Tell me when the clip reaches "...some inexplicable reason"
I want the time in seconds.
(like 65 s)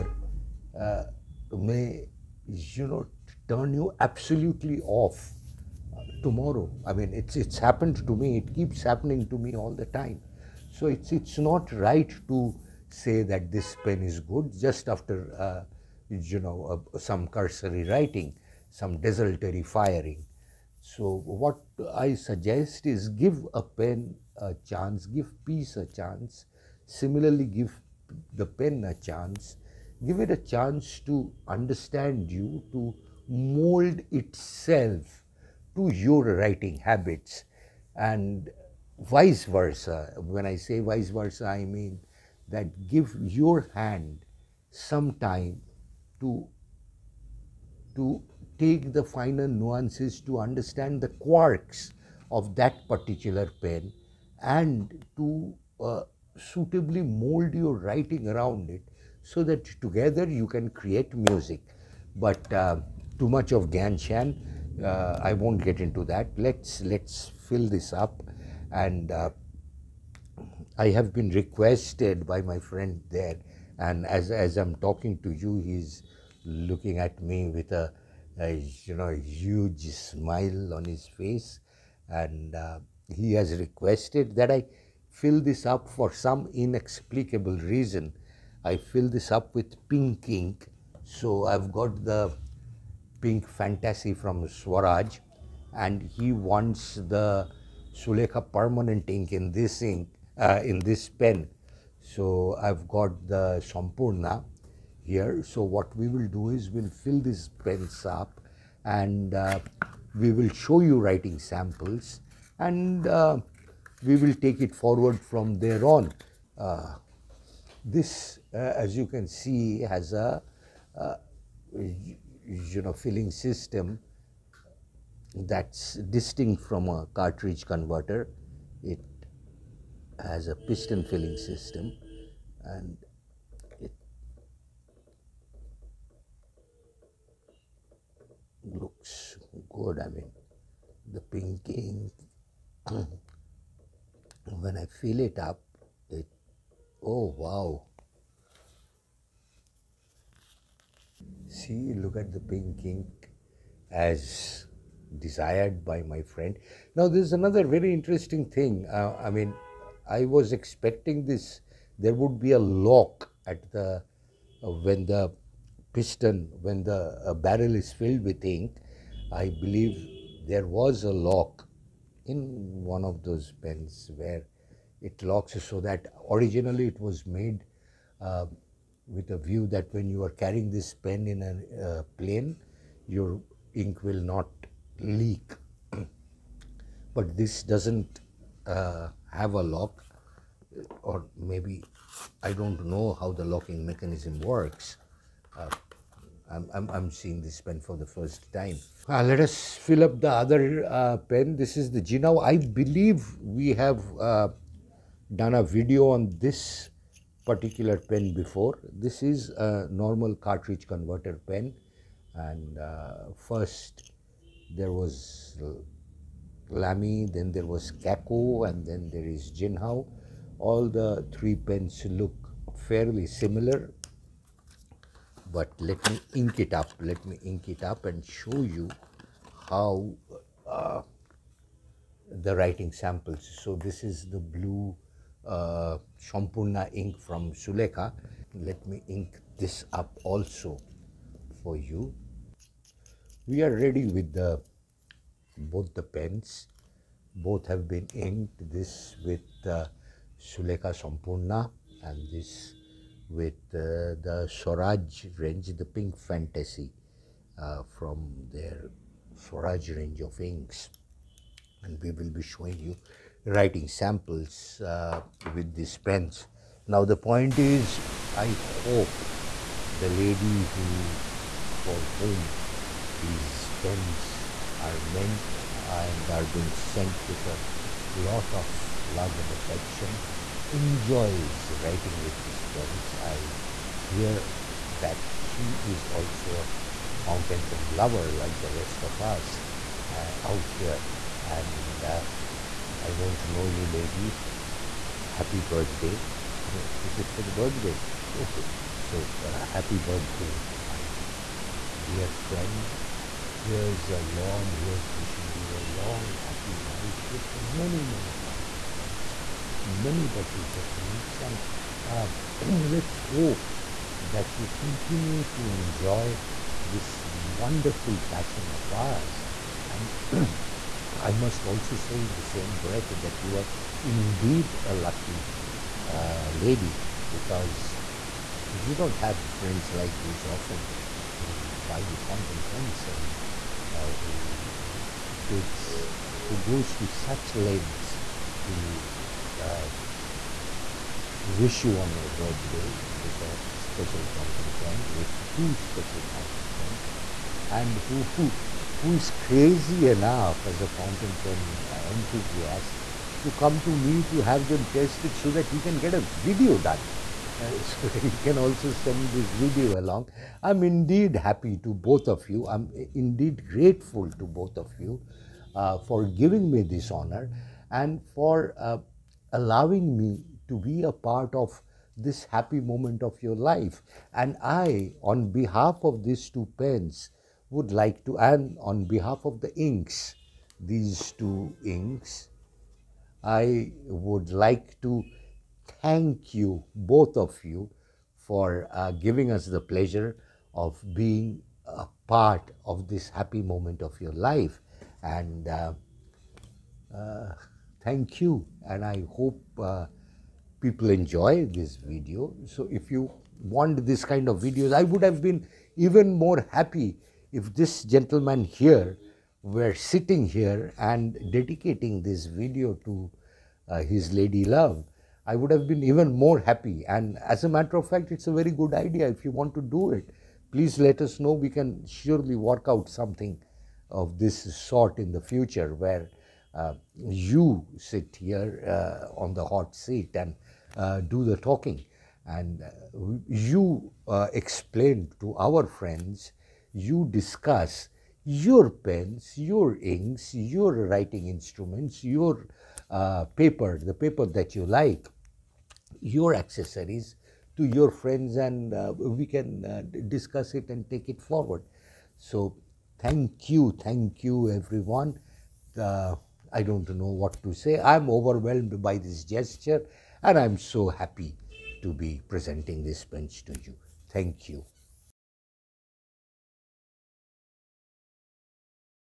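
86 s.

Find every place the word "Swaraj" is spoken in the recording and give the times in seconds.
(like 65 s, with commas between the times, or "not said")
94 s, 254 s, 259 s.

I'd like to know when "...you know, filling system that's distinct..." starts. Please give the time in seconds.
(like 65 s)
121 s.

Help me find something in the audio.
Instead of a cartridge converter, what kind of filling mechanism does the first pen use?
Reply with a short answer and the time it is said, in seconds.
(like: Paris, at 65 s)
Piston filling system, at 130 s.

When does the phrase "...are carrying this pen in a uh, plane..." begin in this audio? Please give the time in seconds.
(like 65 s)
180 s.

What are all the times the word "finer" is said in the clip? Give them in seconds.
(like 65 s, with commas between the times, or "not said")
49 s.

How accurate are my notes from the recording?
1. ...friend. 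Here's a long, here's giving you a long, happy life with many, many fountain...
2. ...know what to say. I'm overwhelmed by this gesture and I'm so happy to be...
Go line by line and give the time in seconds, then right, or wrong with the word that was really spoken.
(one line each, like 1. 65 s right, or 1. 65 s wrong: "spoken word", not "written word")
1. 302 s wrong: "wishing", not "giving"
2. 457 s right.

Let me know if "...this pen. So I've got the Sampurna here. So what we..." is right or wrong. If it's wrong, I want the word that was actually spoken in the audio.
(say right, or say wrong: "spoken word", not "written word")
right.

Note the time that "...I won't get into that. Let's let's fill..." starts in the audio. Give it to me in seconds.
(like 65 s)
65 s.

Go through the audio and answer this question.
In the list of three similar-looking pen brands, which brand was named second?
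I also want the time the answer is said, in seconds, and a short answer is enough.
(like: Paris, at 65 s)
Kaco, at 217 s.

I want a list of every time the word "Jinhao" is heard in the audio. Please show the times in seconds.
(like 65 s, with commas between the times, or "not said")
201 s, 219 s.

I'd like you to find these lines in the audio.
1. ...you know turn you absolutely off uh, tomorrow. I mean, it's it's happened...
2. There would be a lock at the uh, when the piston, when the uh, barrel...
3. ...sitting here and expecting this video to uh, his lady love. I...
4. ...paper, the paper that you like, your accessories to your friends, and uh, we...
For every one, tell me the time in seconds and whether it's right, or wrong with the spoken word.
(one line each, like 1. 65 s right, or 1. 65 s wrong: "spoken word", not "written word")
1. 2 s right
2. 161 s right
3. 409 s wrong: "dedicating", not "expecting"
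4. 443 s right.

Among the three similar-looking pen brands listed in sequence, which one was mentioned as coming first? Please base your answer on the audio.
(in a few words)
Lamy.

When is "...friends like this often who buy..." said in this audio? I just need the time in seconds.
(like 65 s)
329 s.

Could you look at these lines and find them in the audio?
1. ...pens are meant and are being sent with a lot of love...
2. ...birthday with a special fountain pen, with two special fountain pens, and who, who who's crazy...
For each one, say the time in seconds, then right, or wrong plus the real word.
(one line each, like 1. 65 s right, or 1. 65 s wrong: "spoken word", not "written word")
1. 273 s right
2. 342 s right.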